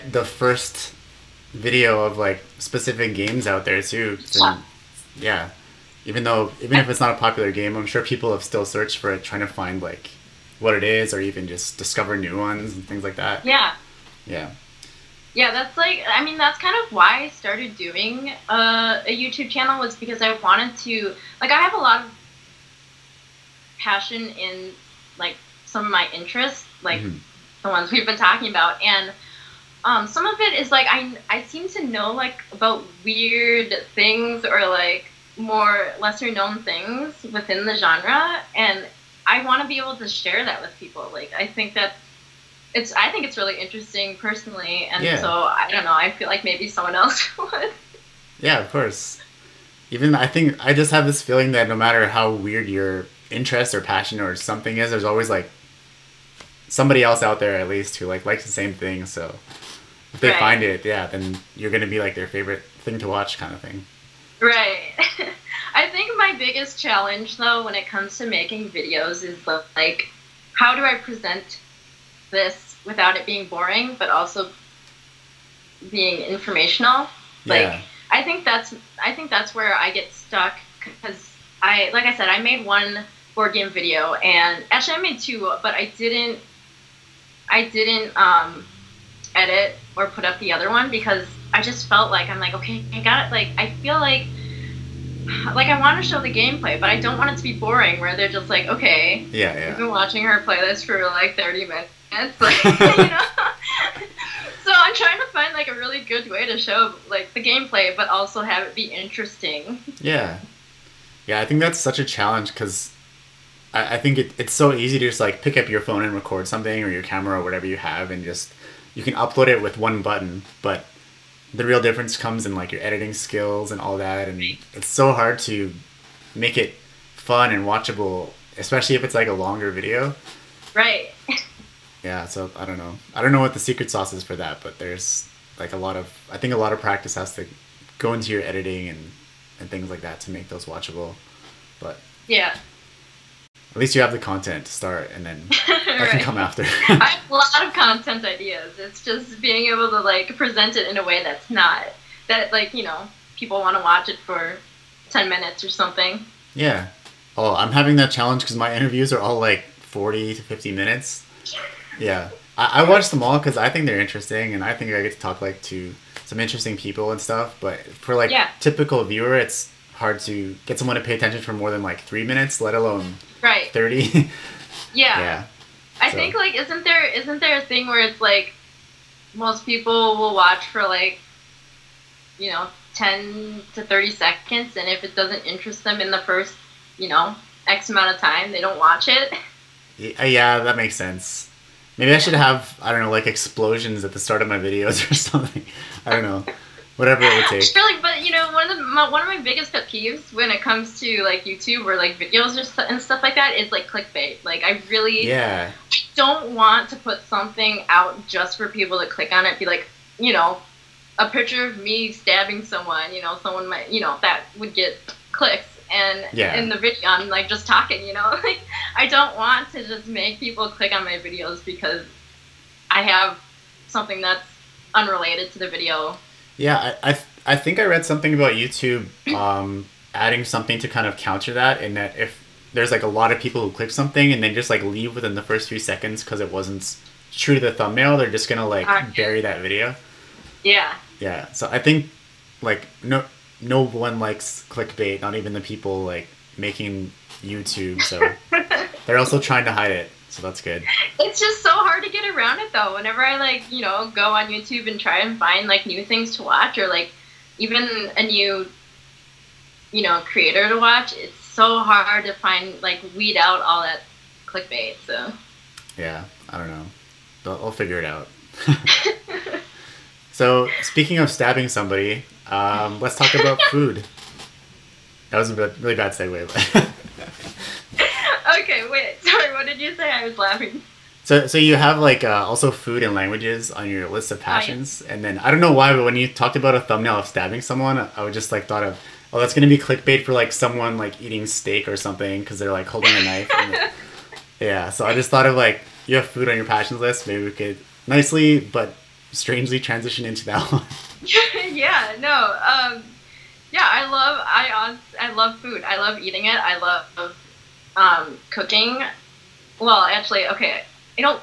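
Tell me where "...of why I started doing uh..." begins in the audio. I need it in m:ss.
0:16.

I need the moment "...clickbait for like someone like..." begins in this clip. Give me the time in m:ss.
4:49.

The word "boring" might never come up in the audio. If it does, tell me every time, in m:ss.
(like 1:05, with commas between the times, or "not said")
1:13, 1:37.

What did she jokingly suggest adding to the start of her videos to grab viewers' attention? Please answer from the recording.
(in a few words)
Explosions.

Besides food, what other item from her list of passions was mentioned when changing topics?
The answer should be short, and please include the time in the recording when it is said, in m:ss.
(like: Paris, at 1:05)
Languages, at 4:43.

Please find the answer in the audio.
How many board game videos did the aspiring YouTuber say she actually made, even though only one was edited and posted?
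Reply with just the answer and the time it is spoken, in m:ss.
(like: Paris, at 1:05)
2, at 1:25.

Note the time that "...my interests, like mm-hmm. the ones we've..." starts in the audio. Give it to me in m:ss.
0:25.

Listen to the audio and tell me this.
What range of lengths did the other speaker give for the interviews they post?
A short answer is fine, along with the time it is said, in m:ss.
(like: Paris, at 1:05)
40 to 50 minutes, at 2:39.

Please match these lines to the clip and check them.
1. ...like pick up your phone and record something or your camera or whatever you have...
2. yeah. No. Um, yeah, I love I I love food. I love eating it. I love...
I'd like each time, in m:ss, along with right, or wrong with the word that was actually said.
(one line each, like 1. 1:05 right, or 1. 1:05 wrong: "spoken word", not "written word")
1. 1:55 right
2. 5:01 right.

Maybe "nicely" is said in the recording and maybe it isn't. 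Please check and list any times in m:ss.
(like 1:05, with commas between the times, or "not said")
4:58.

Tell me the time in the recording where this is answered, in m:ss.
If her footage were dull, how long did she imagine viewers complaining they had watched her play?
1:41.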